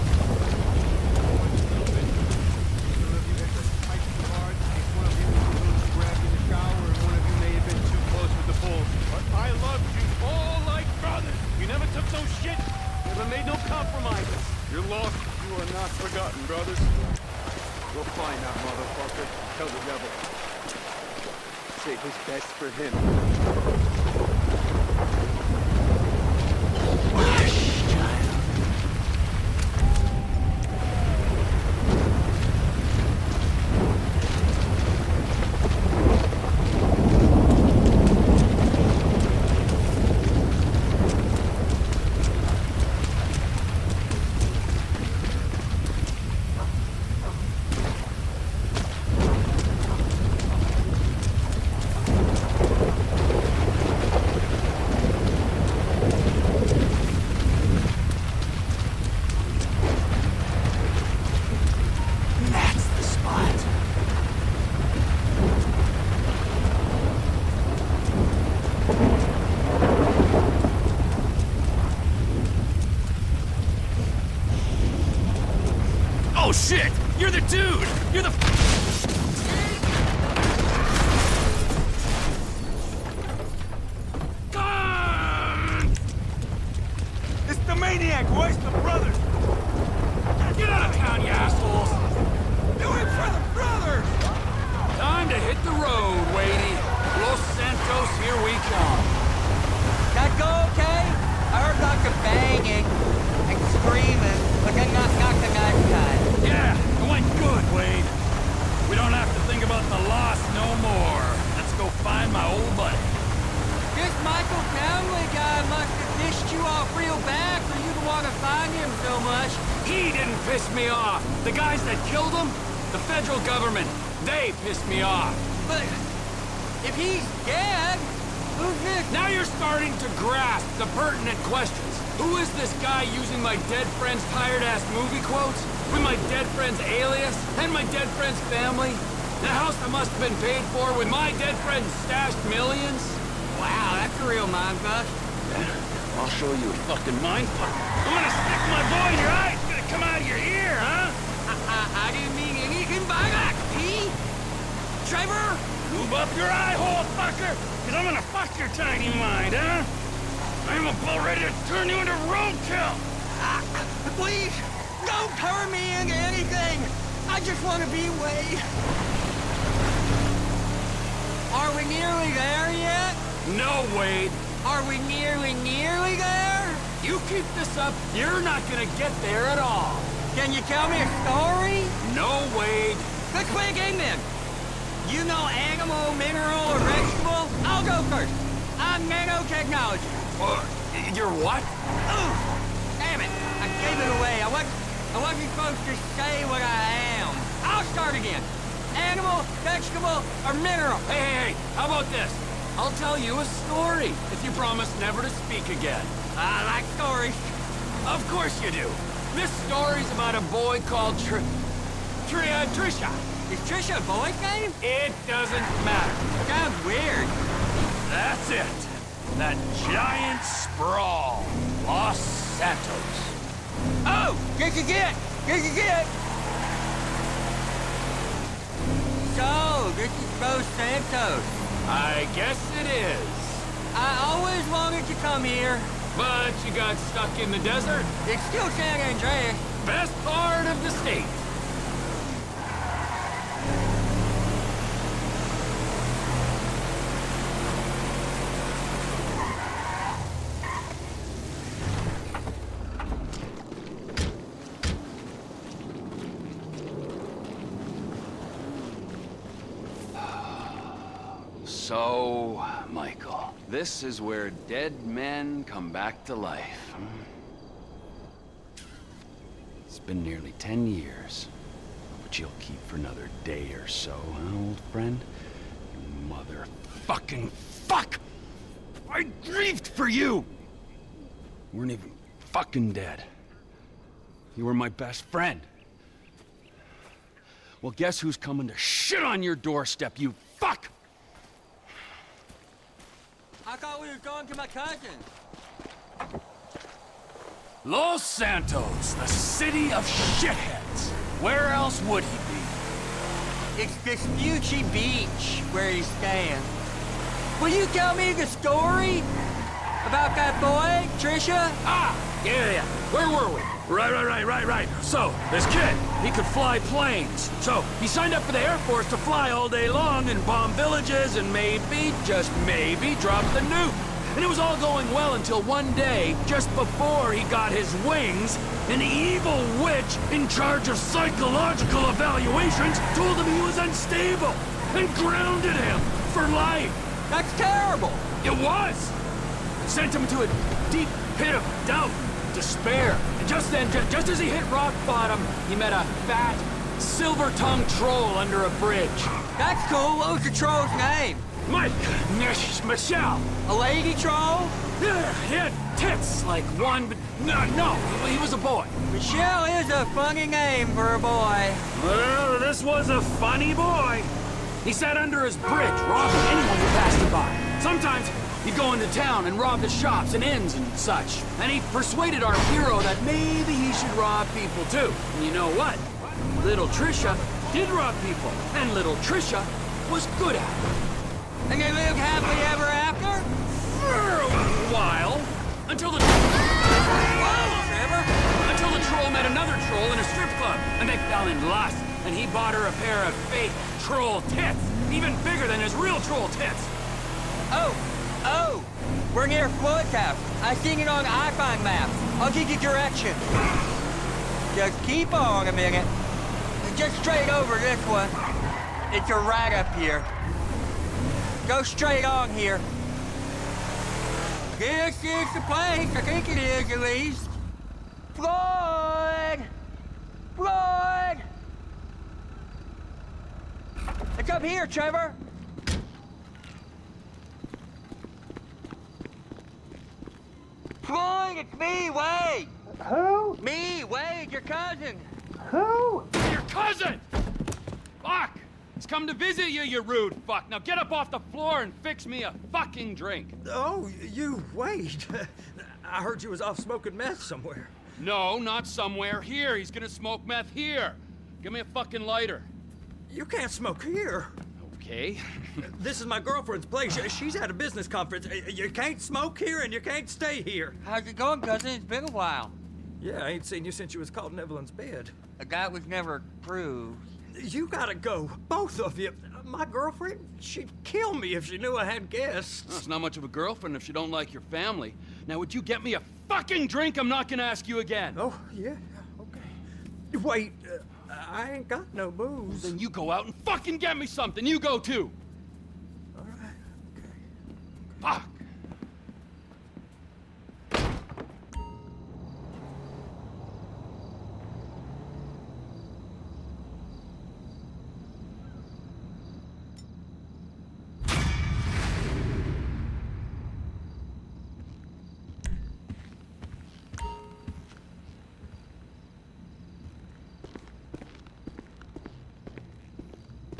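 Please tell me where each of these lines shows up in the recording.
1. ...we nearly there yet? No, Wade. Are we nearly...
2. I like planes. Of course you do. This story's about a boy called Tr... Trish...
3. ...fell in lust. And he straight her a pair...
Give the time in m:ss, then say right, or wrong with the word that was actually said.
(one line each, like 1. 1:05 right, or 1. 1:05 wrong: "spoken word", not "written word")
1. 2:51 right
2. 3:26 wrong: "stories", not "planes"
3. 6:31 wrong: "bought", not "straight".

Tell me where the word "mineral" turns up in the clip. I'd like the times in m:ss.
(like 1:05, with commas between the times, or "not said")
3:06, 3:20.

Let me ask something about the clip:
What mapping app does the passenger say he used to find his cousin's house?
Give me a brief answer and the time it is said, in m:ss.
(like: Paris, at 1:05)
iFind maps, at 6:41.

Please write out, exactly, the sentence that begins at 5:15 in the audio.
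So, this kid, he could fly planes.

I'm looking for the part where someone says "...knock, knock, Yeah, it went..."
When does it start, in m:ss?
1:45.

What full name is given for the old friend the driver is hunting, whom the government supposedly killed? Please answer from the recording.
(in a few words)
Michael Townley.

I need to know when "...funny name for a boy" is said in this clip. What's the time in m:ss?
6:00.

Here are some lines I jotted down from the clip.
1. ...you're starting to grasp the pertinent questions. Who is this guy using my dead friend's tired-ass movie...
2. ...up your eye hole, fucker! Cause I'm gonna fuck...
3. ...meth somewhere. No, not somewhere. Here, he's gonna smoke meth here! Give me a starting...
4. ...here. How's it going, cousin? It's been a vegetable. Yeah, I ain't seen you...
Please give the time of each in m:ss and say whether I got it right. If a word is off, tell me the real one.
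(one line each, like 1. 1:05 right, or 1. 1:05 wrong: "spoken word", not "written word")
1. 2:09 right
2. 2:36 right
3. 7:27 wrong: "fucking", not "starting"
4. 7:40 wrong: "while", not "vegetable".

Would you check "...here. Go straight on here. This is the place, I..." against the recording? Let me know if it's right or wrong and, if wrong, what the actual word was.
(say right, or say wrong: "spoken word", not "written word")
right.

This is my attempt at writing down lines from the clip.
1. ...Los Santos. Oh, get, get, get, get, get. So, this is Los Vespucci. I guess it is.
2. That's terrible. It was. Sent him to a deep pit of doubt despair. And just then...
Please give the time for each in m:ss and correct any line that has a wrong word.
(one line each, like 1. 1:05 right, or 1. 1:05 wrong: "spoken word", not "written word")
1. 3:41 wrong: "Santos", not "Vespucci"
2. 5:37 right.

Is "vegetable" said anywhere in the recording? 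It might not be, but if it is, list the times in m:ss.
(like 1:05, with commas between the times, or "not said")
3:06, 3:19.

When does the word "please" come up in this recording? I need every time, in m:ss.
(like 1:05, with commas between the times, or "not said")
2:44.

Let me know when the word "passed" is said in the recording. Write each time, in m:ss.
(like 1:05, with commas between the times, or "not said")
6:06.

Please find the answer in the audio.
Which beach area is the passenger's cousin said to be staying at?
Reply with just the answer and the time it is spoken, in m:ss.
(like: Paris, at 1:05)
Vespucci Beach, at 5:03.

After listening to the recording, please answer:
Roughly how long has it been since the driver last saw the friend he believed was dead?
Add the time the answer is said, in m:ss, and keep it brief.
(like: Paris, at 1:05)
nearly ten years, at 4:30.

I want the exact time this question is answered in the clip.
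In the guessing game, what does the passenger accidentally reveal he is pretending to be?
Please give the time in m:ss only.
3:09.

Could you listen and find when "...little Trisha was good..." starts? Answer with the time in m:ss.
6:18.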